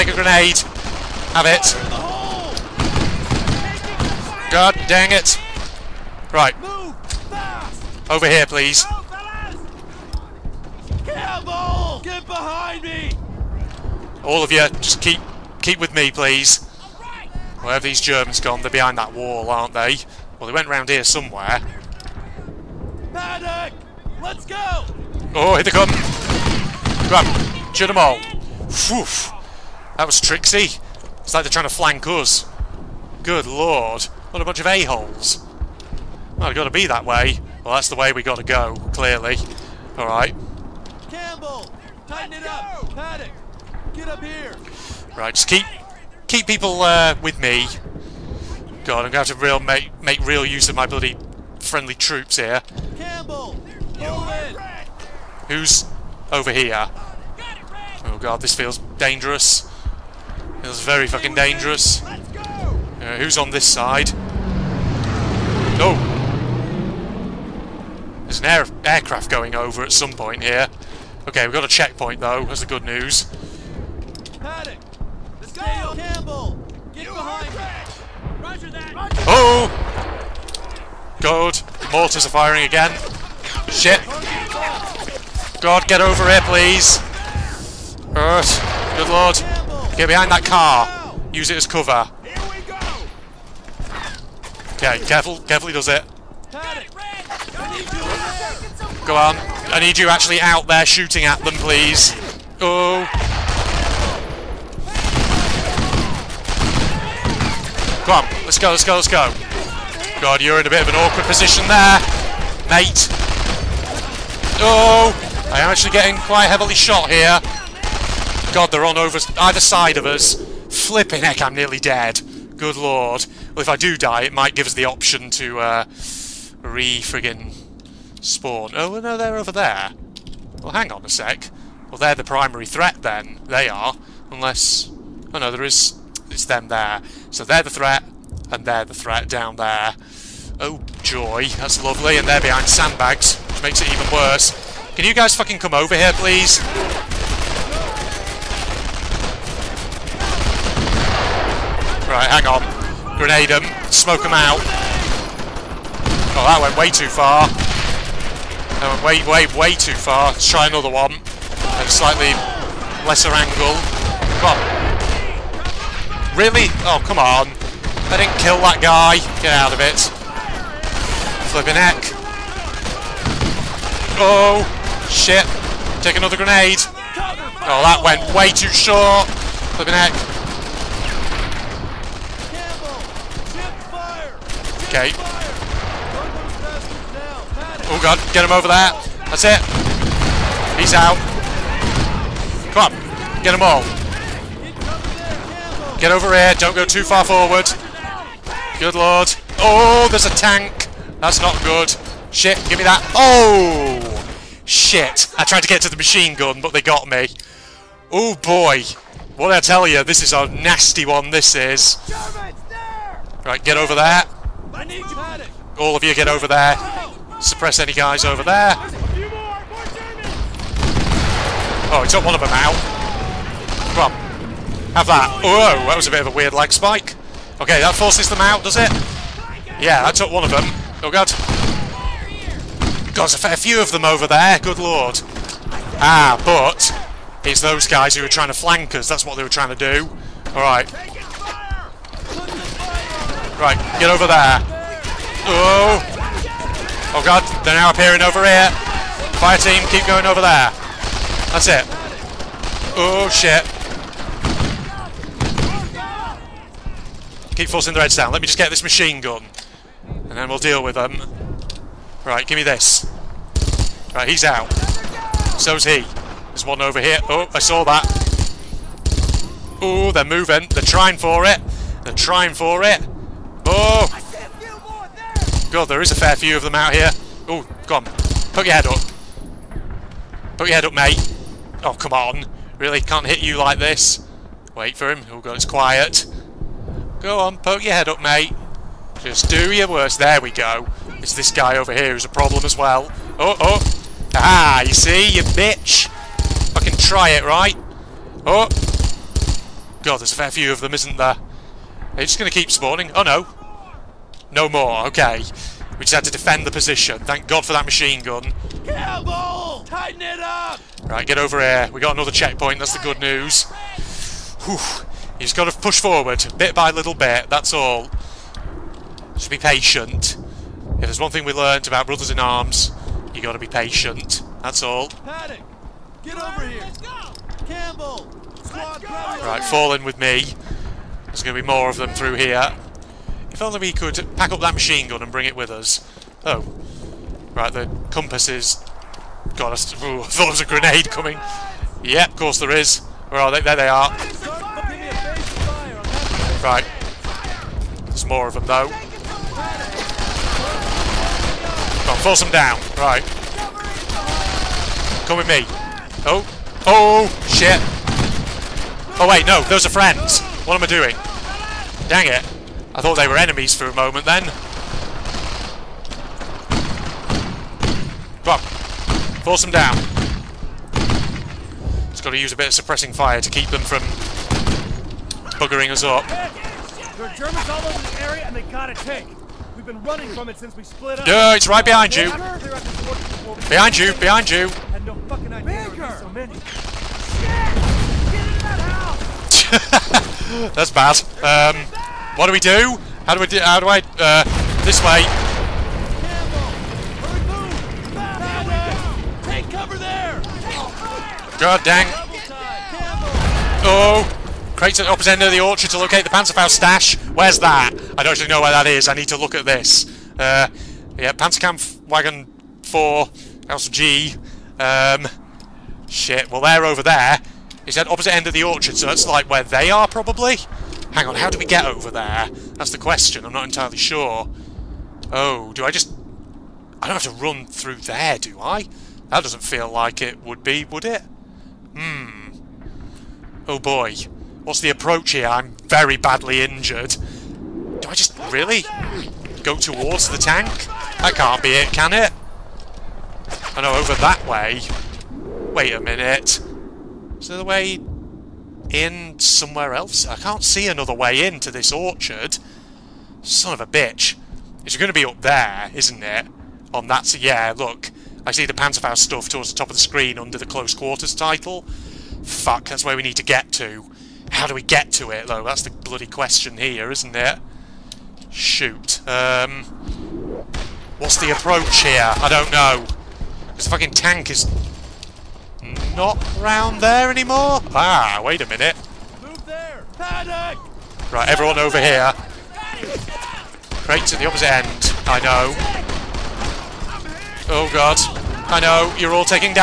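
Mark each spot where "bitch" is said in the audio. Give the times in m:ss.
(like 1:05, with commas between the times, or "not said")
4:55, 7:33.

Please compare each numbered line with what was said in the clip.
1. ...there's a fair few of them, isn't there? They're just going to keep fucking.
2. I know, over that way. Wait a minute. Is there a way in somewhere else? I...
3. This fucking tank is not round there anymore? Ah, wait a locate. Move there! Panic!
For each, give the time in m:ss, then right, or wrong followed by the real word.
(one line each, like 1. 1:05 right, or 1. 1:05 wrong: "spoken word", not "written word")
1. 5:00 wrong: "spawning", not "fucking"
2. 7:23 right
3. 7:53 wrong: "minute", not "locate".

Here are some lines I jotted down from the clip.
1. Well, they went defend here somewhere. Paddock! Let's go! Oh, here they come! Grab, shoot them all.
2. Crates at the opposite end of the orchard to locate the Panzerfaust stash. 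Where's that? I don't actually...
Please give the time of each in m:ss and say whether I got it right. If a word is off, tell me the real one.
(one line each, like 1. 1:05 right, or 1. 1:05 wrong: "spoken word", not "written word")
1. 0:20 wrong: "round", not "defend"
2. 6:44 right.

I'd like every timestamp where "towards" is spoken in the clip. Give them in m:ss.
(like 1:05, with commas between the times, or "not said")
7:19, 7:39.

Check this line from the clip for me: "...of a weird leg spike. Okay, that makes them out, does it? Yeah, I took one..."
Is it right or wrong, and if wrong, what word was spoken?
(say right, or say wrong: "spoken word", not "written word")
wrong: "forces", not "makes".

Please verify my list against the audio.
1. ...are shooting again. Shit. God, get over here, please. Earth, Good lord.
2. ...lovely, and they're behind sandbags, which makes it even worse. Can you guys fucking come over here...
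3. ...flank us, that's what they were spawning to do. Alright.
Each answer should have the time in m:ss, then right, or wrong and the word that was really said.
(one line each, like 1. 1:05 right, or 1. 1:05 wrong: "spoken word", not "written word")
1. 1:22 wrong: "firing", not "shooting"
2. 2:21 right
3. 3:58 wrong: "trying", not "spawning".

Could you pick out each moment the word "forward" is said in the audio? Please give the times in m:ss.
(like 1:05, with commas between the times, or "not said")
3:17, 5:16.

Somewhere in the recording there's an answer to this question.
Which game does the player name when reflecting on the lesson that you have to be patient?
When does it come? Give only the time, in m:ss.
5:22.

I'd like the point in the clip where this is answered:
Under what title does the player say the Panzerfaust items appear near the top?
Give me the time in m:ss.
7:40.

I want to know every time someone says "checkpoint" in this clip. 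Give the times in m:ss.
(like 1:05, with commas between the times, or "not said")
1:11, 5:12.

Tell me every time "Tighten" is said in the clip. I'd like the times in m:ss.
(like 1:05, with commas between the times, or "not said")
0:42, 5:09.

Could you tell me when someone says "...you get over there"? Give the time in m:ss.
3:36.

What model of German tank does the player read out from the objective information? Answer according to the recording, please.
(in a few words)
Panzerkampfwagen 4.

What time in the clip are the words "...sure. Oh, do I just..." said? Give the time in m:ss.
7:03.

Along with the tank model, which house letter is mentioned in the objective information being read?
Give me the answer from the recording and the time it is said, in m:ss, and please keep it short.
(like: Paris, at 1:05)
House G, at 6:53.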